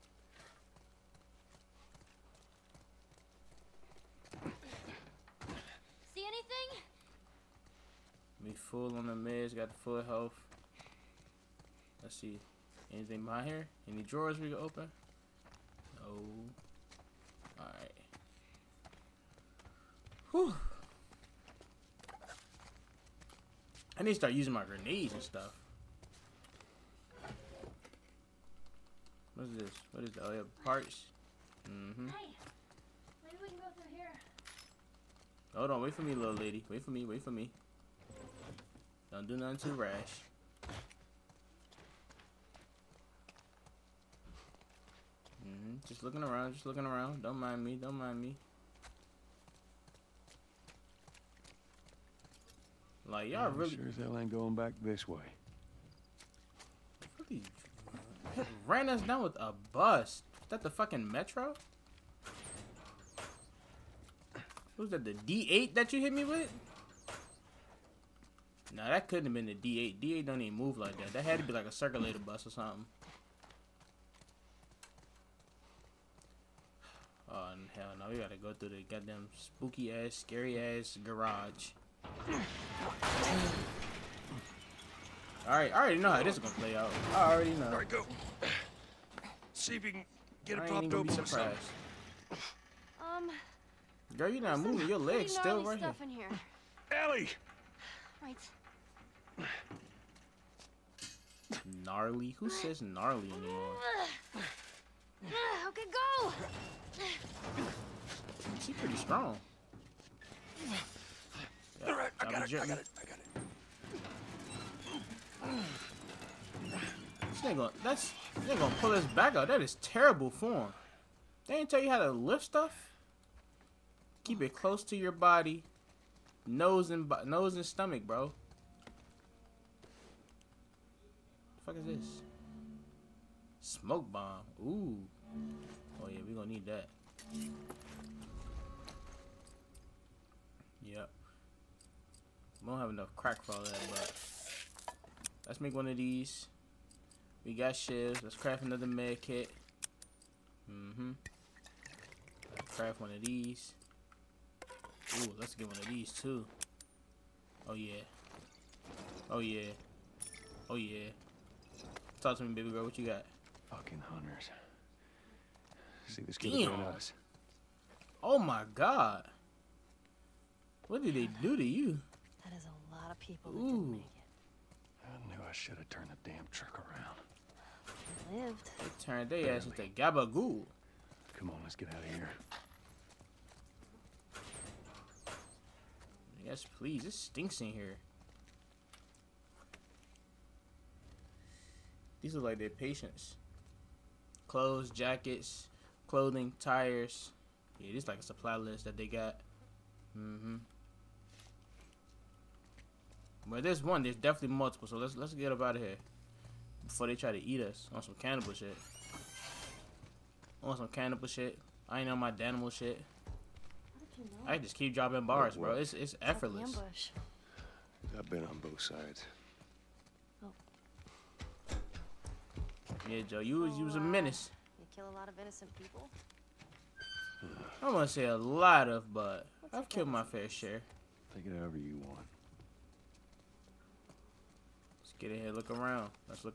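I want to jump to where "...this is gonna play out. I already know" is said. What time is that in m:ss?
1:26.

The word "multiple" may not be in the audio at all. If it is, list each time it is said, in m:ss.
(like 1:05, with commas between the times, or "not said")
3:24.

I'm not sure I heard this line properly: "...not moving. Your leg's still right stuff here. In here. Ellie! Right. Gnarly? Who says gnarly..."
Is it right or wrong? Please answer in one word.
right.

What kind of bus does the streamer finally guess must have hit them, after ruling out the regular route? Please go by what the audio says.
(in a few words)
circulator bus.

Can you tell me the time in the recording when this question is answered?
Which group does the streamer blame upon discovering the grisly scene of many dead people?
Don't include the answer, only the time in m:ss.
2:44.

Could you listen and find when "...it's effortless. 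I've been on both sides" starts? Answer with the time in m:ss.
3:35.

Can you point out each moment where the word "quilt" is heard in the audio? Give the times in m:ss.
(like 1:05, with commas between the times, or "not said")
not said.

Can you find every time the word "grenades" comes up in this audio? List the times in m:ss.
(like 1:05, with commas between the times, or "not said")
0:24.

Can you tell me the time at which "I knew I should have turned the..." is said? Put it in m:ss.
2:55.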